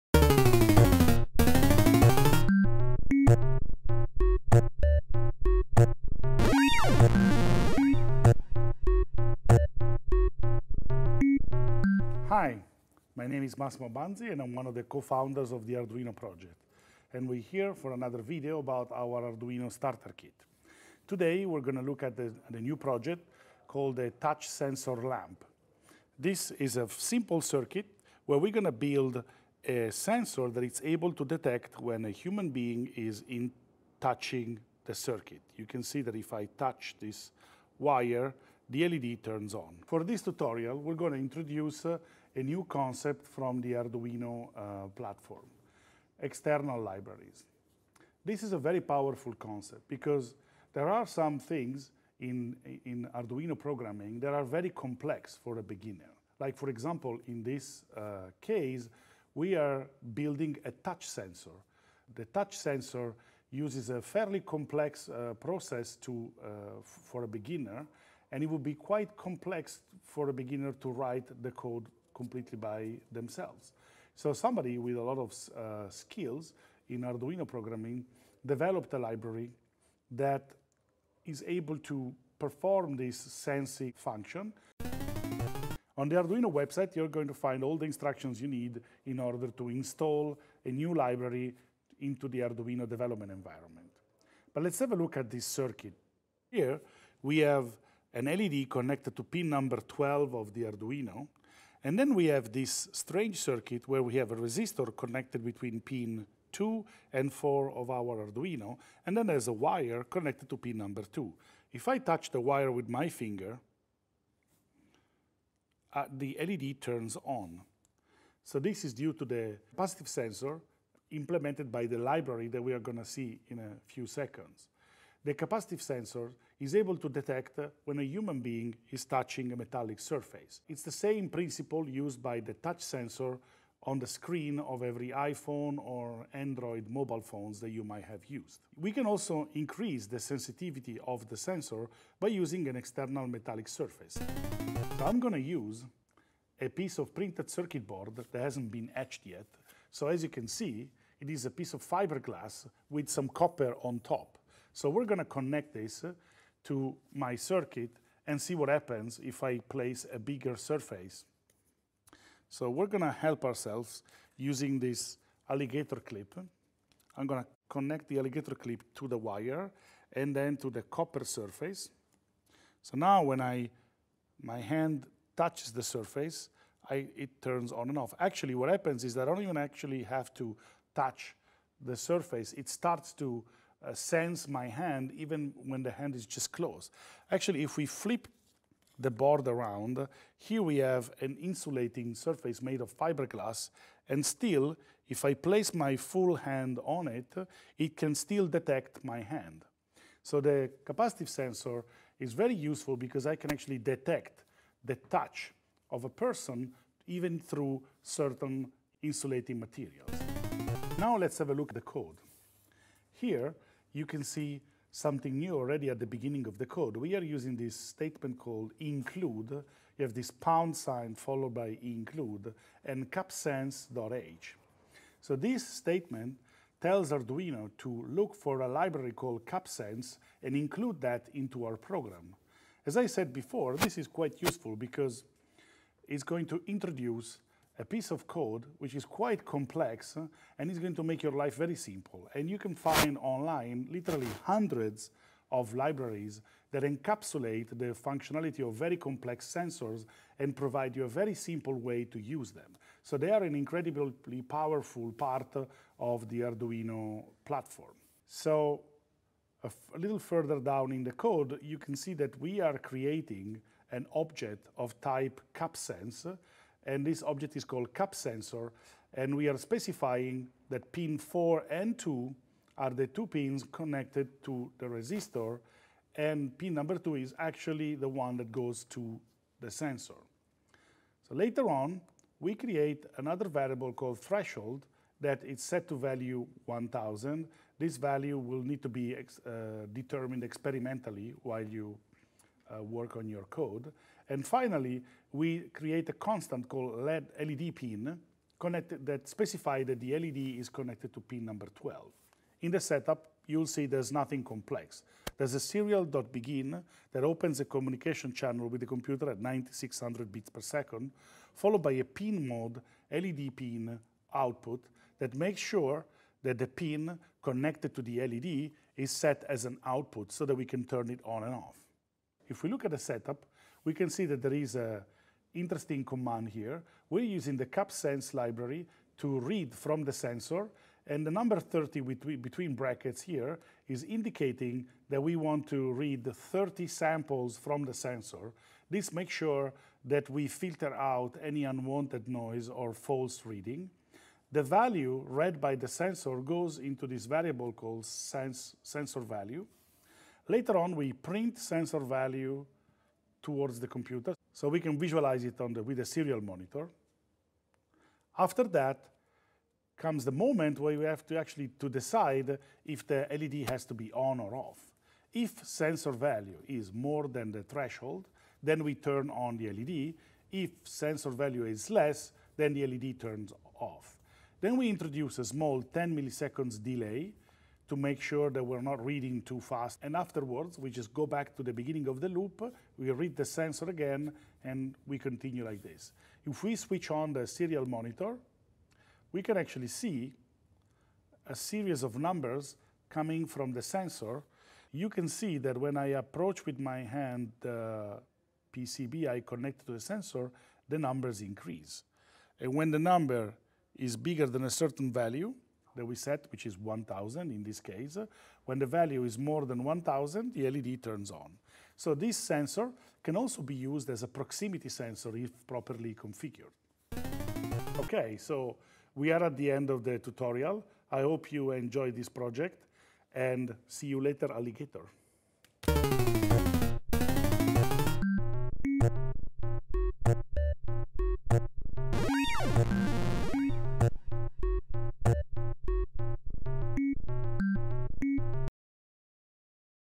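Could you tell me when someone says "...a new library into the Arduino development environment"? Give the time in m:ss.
1:30.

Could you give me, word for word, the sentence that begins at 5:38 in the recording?
This makes sure that we filter out any unwanted noise or false reading.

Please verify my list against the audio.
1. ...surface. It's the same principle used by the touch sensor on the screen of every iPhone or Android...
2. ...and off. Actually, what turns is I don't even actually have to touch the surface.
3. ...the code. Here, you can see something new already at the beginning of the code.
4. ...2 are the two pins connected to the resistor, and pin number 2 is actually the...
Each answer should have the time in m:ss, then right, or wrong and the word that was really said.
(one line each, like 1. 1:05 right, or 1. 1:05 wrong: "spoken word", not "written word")
1. 2:09 right
2. 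2:57 wrong: "happens", not "turns"
3. 3:31 right
4. 4:31 right.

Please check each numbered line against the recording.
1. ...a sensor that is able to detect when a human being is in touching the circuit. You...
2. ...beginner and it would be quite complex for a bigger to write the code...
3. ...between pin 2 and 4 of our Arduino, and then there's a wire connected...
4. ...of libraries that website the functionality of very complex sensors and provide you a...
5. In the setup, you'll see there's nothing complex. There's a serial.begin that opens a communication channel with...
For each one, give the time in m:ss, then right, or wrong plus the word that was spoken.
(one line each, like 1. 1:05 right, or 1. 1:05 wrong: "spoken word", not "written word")
1. 0:29 right
2. 1:07 wrong: "beginner", not "bigger"
3. 1:45 right
4. 4:05 wrong: "encapsulate", not "website"
5. 5:02 right.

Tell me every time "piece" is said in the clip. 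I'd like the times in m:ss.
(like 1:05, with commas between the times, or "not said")
2:26, 2:31, 3:57.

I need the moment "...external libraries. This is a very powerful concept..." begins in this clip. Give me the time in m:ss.
0:46.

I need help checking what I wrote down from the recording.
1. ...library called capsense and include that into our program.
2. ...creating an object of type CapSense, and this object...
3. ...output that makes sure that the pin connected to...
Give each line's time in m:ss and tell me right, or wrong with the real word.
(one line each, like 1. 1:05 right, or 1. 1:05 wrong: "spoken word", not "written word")
1. 3:48 right
2. 4:22 right
3. 5:14 right.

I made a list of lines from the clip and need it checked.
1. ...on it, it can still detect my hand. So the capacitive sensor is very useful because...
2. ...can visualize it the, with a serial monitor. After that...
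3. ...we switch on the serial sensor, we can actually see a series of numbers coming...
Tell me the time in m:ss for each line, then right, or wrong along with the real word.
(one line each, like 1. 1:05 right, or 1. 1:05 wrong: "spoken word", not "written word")
1. 3:16 right
2. 5:54 right
3. 6:26 wrong: "monitor", not "sensor".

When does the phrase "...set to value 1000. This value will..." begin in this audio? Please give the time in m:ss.
4:45.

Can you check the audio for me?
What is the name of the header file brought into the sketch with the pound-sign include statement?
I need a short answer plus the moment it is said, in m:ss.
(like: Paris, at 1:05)
capsense.h, at 3:43.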